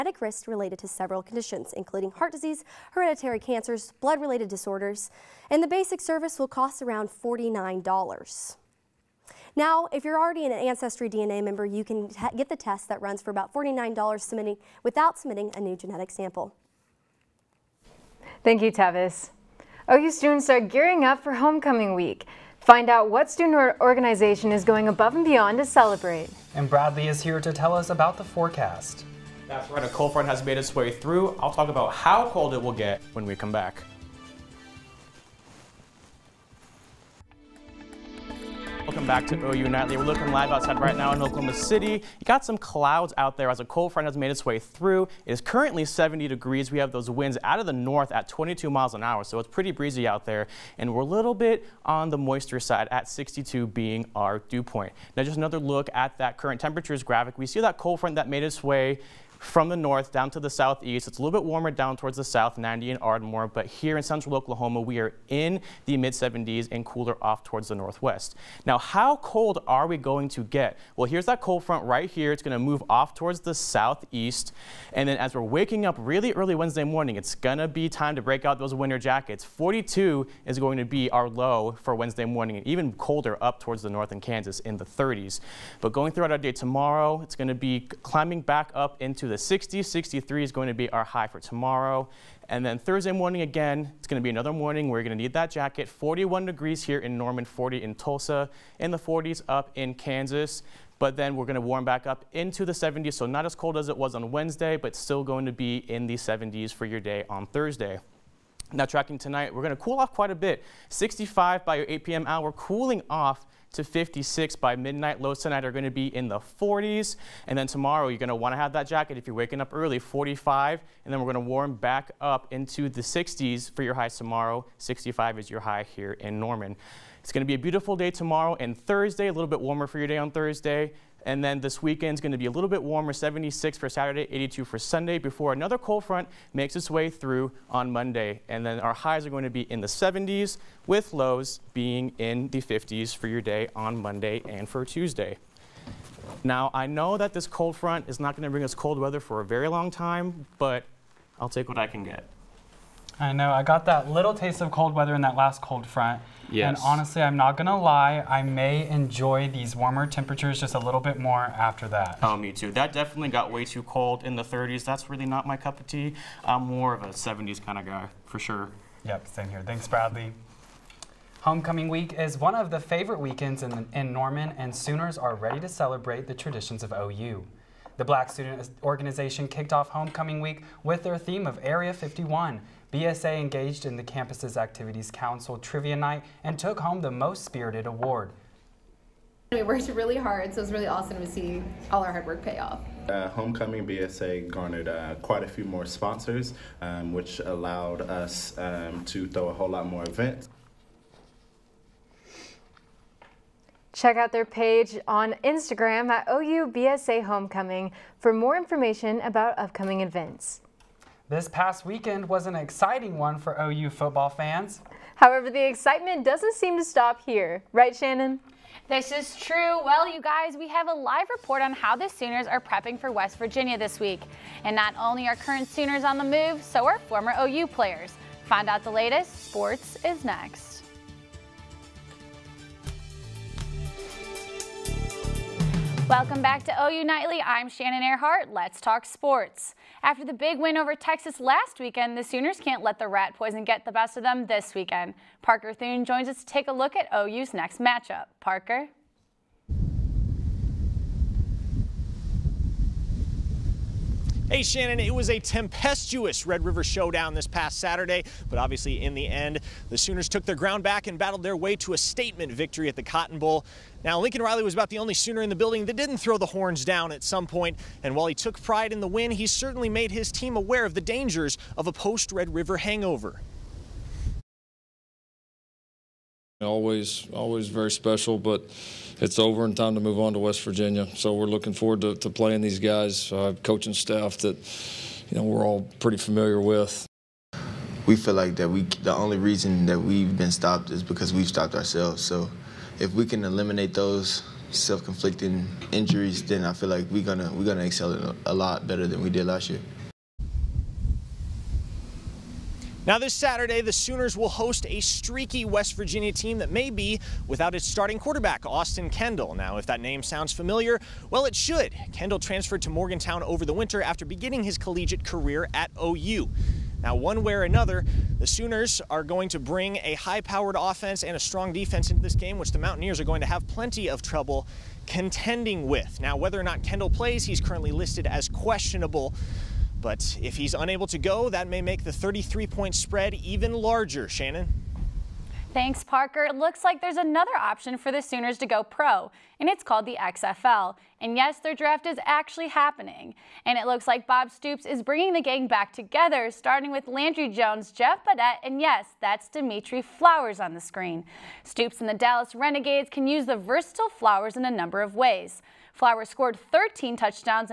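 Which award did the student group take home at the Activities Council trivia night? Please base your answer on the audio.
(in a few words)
most spirited award.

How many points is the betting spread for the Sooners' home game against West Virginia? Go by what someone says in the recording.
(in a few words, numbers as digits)
33.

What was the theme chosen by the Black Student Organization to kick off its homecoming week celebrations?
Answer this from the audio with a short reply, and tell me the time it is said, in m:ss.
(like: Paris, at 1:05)
Area 51, at 3:01.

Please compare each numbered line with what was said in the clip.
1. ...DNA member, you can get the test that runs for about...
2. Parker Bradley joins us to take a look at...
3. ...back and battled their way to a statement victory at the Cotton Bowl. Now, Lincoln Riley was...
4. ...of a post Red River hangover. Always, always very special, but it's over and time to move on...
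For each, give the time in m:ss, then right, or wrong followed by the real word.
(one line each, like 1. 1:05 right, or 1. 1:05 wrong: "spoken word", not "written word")
1. 0:11 right
2. 4:05 wrong: "Thune", not "Bradley"
3. 4:20 right
4. 4:31 right.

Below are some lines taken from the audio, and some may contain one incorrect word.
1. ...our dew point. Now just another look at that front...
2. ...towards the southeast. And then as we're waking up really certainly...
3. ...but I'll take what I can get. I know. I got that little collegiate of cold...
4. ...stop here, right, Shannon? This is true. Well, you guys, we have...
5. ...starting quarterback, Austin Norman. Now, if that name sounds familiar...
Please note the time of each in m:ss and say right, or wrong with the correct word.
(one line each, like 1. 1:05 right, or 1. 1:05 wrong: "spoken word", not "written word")
1. 0:54 wrong: "current", not "front"
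2. 1:13 wrong: "early", not "certainly"
3. 2:30 wrong: "taste", not "collegiate"
4. 3:36 right
5. 5:07 wrong: "Kendall", not "Norman".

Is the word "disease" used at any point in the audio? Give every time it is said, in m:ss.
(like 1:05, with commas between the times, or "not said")
0:02.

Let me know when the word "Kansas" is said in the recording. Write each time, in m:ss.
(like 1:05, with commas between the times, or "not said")
1:24, 1:39.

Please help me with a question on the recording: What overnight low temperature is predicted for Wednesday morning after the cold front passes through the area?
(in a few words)
42.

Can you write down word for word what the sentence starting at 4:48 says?
We feel like that we the only reason that we've been stopped is because we've stopped ourselves.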